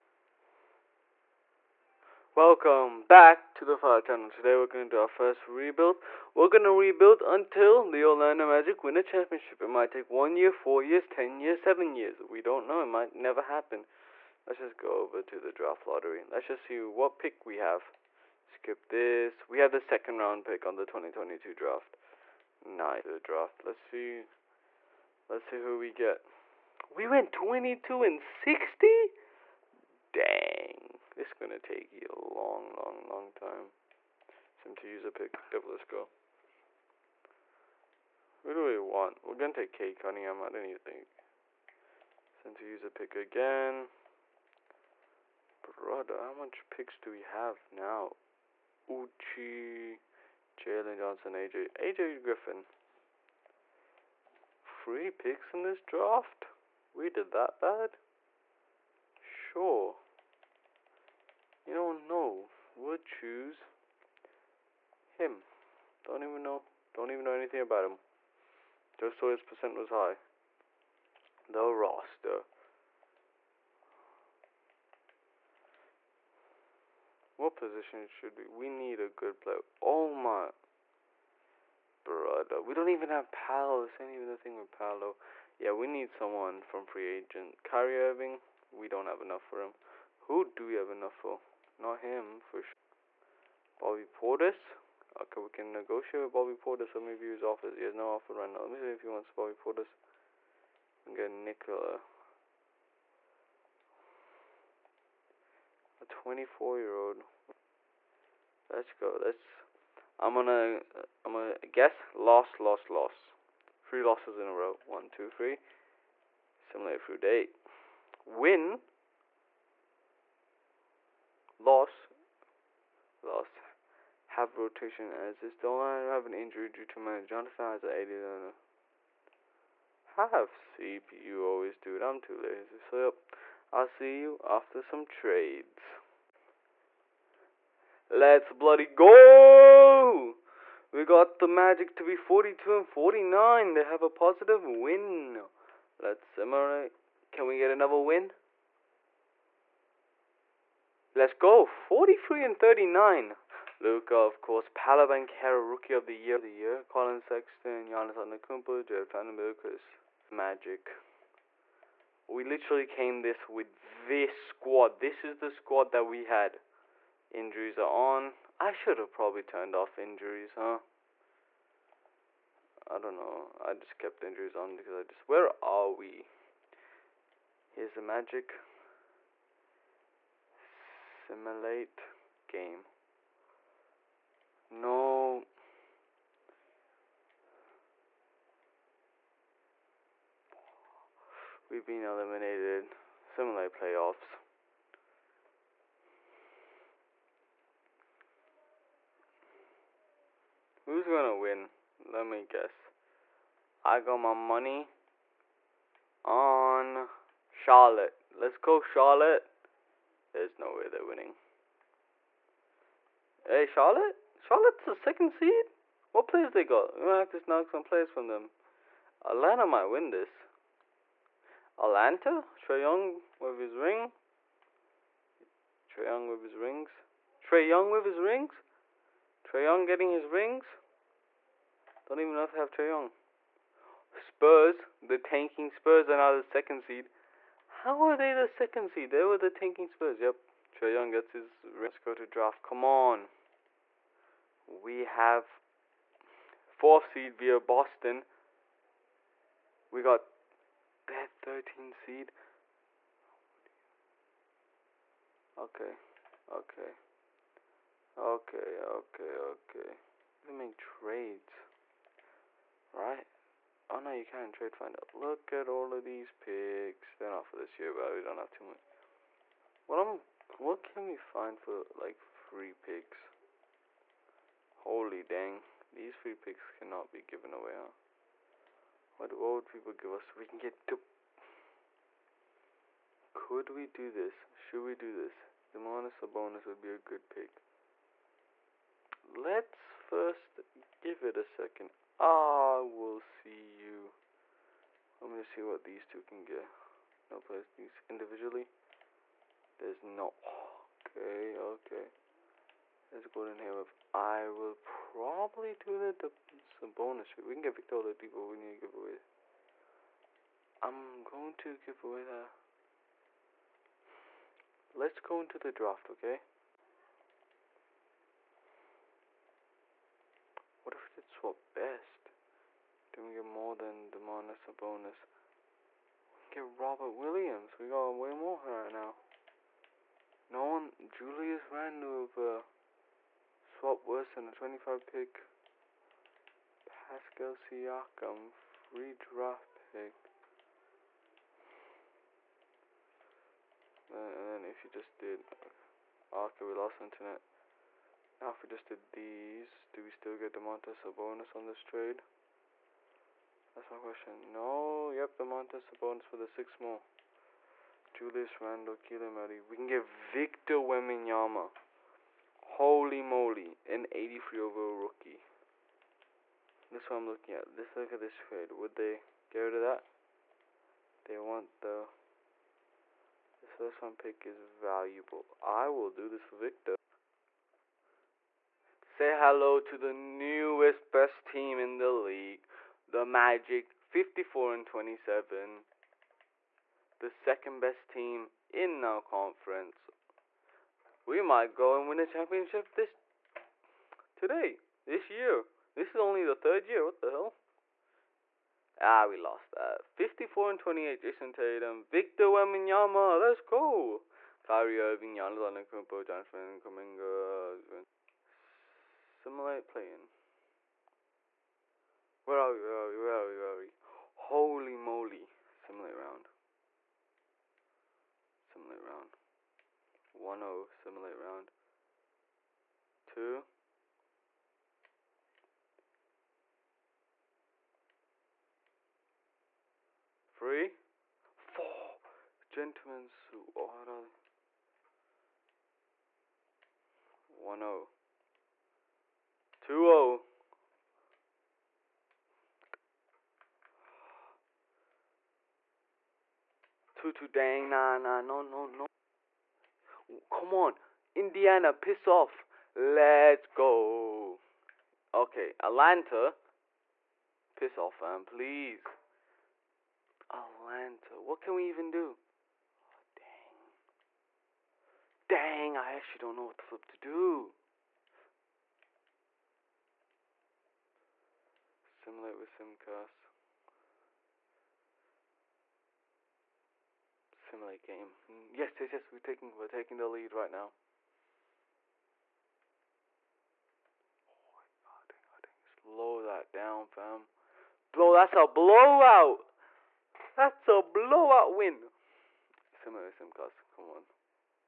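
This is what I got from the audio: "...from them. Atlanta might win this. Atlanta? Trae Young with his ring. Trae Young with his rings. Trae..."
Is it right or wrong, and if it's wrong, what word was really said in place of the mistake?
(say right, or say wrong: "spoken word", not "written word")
right.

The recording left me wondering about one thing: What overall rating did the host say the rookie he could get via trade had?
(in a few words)
83.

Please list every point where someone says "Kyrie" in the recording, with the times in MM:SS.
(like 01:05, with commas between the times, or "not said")
01:27, 06:44.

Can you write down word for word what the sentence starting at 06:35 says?
This is only the third year.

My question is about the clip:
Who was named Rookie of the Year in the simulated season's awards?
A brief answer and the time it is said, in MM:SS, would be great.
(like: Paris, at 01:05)
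Paolo Banchero, at 02:34.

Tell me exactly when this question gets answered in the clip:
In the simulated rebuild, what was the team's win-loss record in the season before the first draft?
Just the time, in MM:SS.
00:27.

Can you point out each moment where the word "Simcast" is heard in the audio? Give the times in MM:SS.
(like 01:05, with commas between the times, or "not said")
07:52, 08:13.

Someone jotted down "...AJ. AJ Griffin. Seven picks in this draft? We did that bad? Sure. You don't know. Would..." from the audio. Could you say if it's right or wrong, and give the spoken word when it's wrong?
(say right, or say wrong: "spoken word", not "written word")
wrong: "Three", not "Seven".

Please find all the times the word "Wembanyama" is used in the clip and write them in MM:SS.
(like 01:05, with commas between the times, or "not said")
06:00, 06:42.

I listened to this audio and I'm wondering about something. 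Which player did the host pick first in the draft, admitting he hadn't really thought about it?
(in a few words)
K Cunningham.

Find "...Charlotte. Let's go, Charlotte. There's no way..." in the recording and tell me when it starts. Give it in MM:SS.
03:27.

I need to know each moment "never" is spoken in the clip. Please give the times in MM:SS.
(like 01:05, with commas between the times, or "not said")
00:13.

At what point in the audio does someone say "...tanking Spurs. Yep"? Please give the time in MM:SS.
03:59.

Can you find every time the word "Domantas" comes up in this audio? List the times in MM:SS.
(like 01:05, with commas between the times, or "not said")
04:45, 05:24, 05:50, 05:55.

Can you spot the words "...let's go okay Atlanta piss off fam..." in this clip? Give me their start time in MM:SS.
07:32.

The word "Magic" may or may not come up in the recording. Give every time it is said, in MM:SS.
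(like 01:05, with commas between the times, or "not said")
00:08, 02:21, 02:40, 02:58, 06:23.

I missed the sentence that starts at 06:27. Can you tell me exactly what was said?
The second best team in our conference.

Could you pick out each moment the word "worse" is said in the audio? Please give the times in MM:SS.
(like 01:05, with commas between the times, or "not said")
05:34.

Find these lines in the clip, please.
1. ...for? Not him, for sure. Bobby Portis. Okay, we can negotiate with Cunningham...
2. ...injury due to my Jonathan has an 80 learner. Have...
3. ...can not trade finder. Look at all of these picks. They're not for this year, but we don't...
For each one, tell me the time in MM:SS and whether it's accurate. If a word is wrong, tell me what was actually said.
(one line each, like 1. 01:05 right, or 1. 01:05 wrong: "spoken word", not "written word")
1. 01:31 wrong: "Bobby", not "Cunningham"
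2. 02:06 right
3. 04:24 right.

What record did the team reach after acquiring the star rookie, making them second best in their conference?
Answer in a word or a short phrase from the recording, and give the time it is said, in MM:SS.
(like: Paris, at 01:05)
54 and 27, at 06:24.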